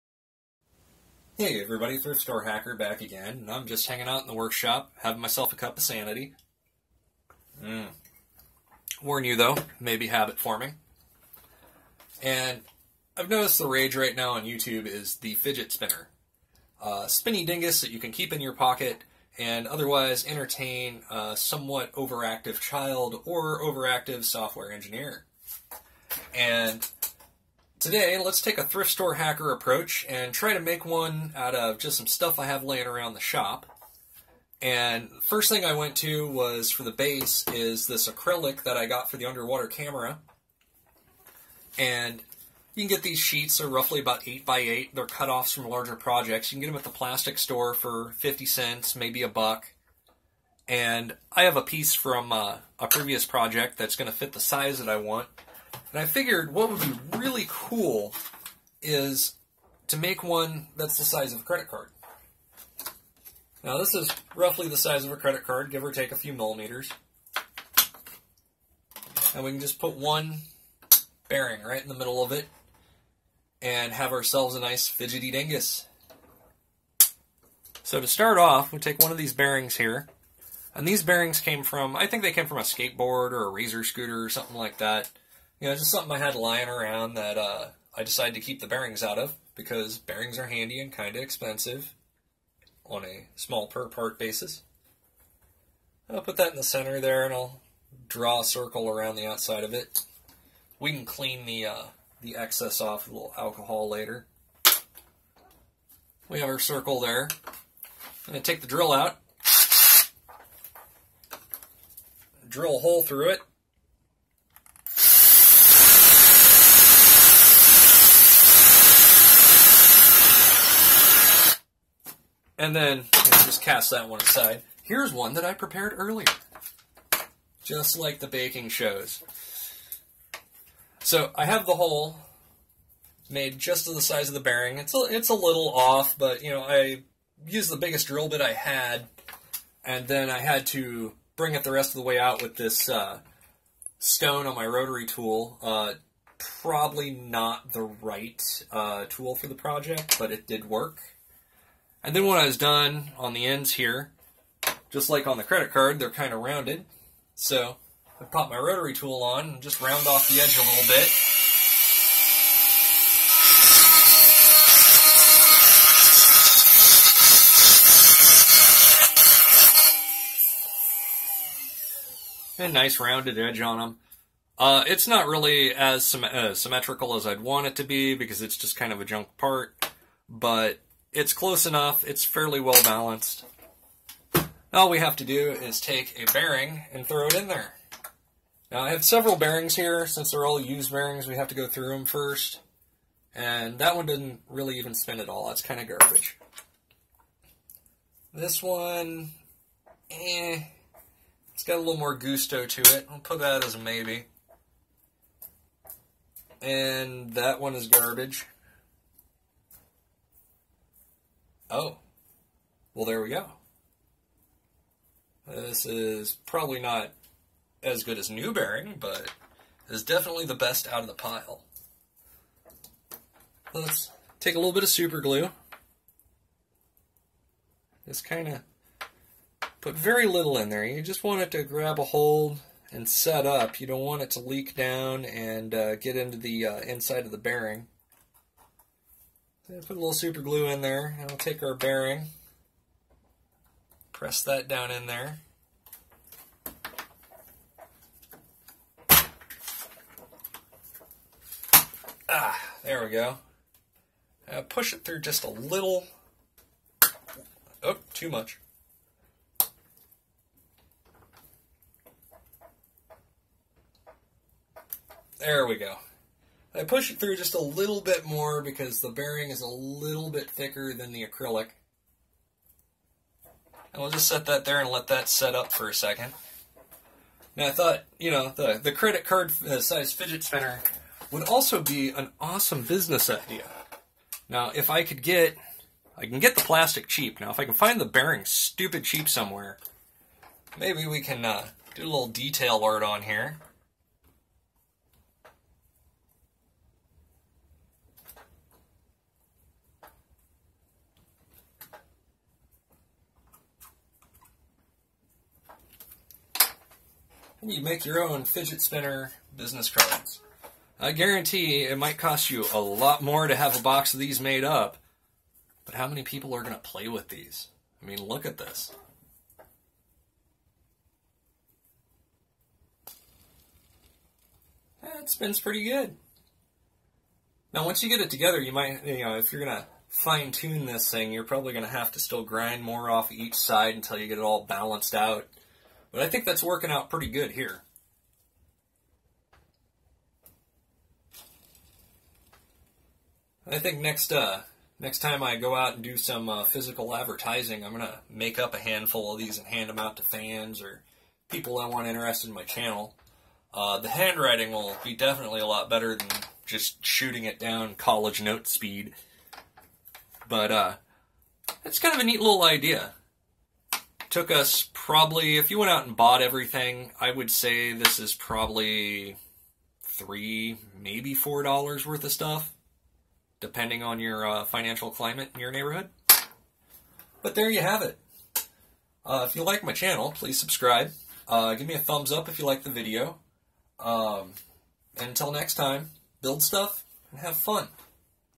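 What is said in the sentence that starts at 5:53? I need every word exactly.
Uh, the handwriting will be definitely a lot better than just shooting it down college note speed.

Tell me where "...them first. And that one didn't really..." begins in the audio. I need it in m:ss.
3:11.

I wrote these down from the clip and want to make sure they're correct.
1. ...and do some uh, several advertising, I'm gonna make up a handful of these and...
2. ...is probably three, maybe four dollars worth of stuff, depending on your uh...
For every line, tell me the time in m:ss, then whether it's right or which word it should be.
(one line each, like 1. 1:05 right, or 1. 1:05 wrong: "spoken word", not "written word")
1. 5:45 wrong: "physical", not "several"
2. 6:08 right.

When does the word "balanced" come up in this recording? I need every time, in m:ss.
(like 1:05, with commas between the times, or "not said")
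3:02, 5:34.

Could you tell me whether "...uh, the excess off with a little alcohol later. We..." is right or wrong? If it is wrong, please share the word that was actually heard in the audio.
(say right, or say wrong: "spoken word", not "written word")
right.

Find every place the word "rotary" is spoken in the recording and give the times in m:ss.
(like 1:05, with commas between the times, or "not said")
2:24, 2:38.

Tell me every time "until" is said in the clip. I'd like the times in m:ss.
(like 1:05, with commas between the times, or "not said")
5:33, 6:25.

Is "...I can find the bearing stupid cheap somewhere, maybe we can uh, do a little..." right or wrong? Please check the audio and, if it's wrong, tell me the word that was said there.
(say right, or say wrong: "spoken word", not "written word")
right.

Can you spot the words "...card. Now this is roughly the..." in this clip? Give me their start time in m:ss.
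1:01.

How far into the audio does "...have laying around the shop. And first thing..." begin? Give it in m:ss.
0:32.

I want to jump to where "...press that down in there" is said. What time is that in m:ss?
4:04.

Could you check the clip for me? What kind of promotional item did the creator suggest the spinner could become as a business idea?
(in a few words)
Business cards.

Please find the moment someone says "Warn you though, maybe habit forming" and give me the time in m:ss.
0:09.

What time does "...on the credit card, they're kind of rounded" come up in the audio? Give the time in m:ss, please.
2:35.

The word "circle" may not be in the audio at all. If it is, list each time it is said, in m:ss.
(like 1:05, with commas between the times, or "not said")
1:38, 1:46.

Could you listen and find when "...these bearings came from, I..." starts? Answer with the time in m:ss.
1:20.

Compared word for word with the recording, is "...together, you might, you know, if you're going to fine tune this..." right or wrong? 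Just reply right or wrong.
right.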